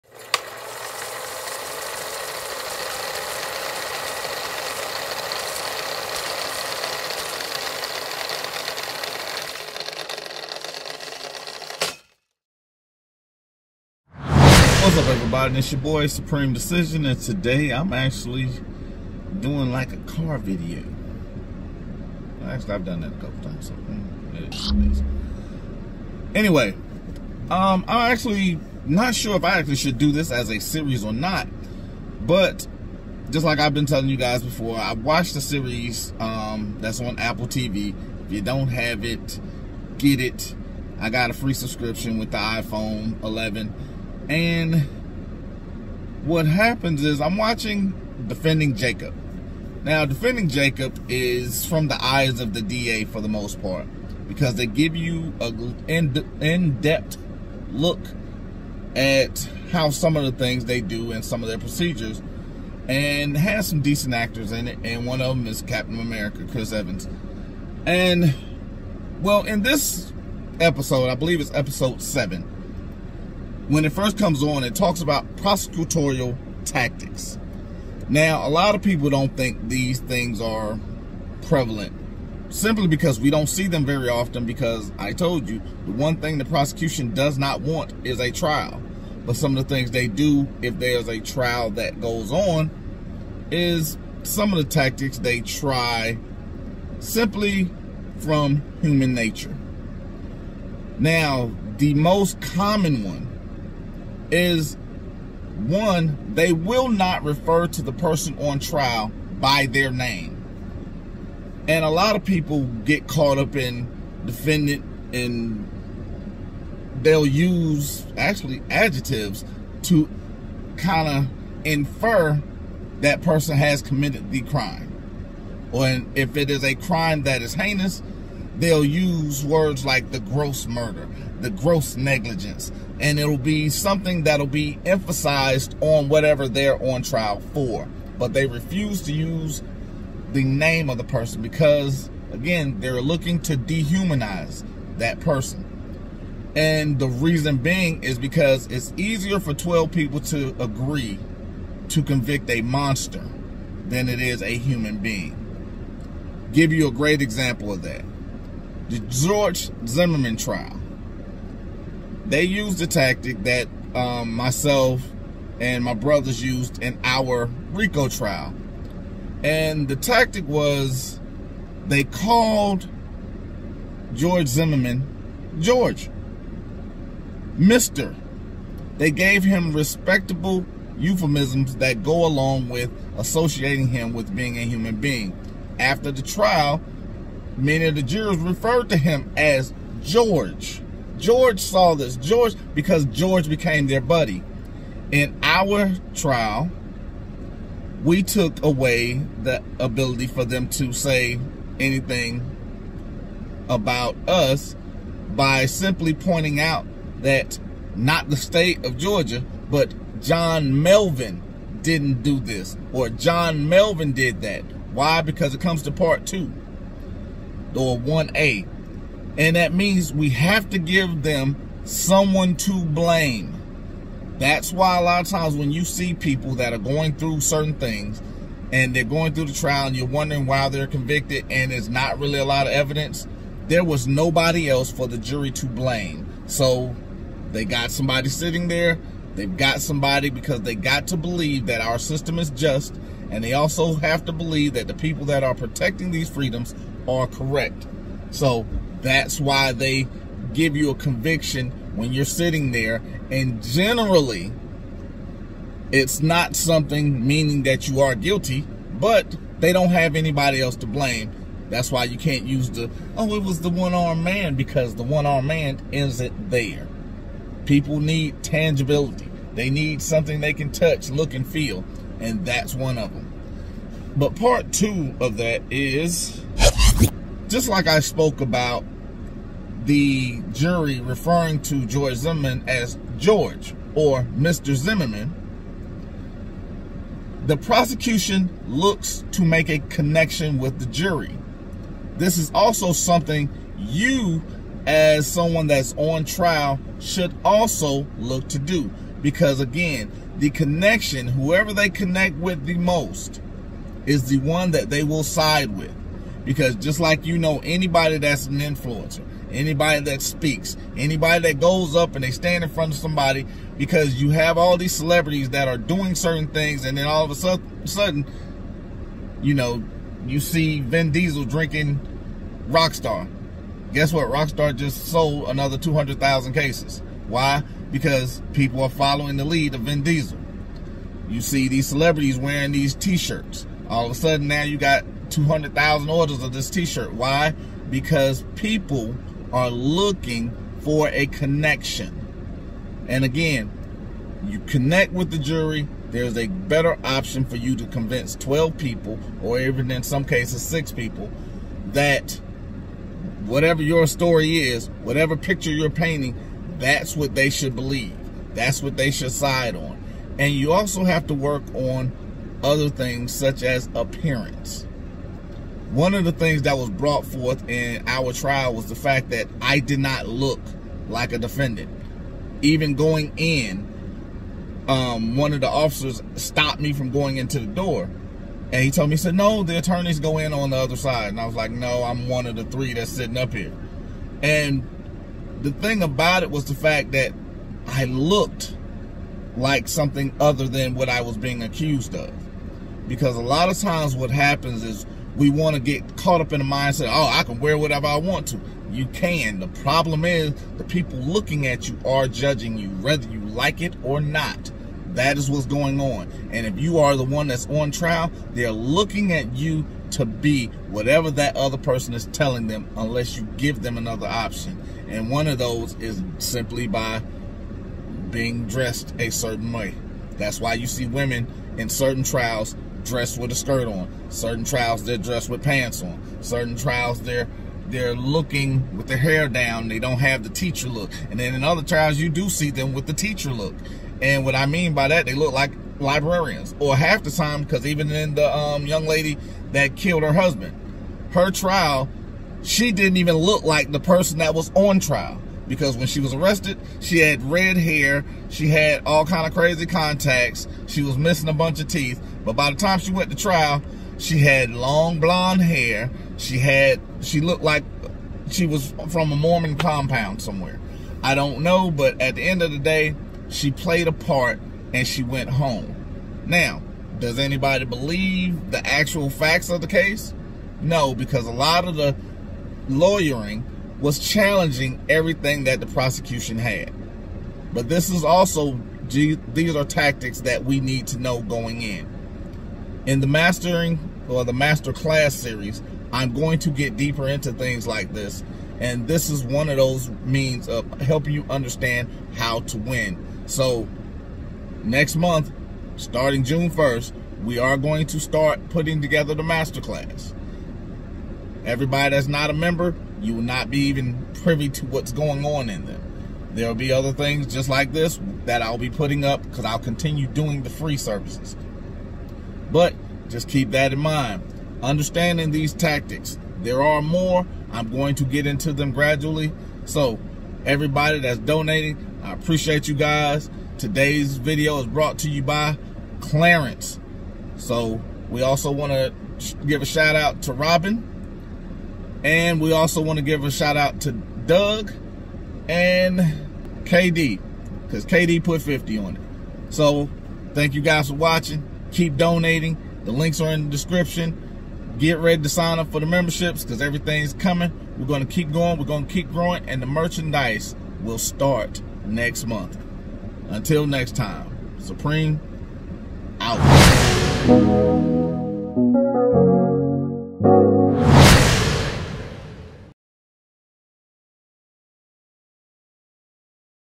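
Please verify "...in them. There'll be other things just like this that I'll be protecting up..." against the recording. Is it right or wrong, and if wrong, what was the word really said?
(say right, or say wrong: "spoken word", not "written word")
wrong: "putting", not "protecting".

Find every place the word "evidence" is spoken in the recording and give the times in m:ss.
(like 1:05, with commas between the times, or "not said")
3:52.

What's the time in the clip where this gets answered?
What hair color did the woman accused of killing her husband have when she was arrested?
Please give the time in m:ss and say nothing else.
7:27.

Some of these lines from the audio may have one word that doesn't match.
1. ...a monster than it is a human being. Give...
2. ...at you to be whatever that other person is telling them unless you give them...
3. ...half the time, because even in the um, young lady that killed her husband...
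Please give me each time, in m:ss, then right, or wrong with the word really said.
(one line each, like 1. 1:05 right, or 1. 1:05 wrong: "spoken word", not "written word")
1. 2:32 right
2. 6:49 right
3. 7:16 right.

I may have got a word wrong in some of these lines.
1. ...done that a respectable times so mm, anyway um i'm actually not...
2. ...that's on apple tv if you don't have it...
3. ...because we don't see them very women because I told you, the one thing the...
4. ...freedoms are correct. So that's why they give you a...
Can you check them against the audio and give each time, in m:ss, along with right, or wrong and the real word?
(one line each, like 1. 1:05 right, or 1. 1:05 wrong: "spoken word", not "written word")
1. 0:22 wrong: "couple", not "respectable"
2. 0:36 right
3. 1:22 wrong: "often", not "women"
4. 4:06 right.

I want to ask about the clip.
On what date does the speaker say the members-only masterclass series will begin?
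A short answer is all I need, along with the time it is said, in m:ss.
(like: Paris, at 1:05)
June 1st, at 8:16.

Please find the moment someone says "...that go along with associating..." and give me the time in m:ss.
3:01.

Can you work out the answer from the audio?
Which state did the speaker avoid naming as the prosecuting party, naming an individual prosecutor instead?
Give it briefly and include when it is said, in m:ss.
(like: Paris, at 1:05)
Georgia, at 3:28.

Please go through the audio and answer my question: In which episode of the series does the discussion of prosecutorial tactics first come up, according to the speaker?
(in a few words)
7.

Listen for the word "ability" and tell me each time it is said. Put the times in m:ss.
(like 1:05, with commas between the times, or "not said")
3:19.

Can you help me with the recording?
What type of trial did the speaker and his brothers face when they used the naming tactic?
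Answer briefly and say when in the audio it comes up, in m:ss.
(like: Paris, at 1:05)
RICO, at 2:47.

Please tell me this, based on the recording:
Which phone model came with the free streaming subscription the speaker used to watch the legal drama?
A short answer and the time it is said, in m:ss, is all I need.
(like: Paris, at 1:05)
iPhone 11, at 0:42.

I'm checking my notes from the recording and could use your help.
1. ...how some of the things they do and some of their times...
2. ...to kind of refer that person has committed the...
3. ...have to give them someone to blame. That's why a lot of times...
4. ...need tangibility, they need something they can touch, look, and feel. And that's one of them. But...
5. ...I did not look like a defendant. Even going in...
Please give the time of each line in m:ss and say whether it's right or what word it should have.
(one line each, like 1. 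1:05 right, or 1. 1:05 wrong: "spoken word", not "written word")
1. 0:59 wrong: "procedures", not "times"
2. 1:59 wrong: "infer", not "refer"
3. 3:40 right
4. 4:28 right
5. 6:09 right.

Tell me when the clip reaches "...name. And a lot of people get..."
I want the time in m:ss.
1:49.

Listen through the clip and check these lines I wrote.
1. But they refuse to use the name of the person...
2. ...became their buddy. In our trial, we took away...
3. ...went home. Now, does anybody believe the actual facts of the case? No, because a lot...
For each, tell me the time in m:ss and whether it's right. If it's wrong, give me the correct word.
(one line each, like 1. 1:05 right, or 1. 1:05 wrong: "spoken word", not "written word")
1. 2:18 right
2. 3:13 right
3. 7:45 right.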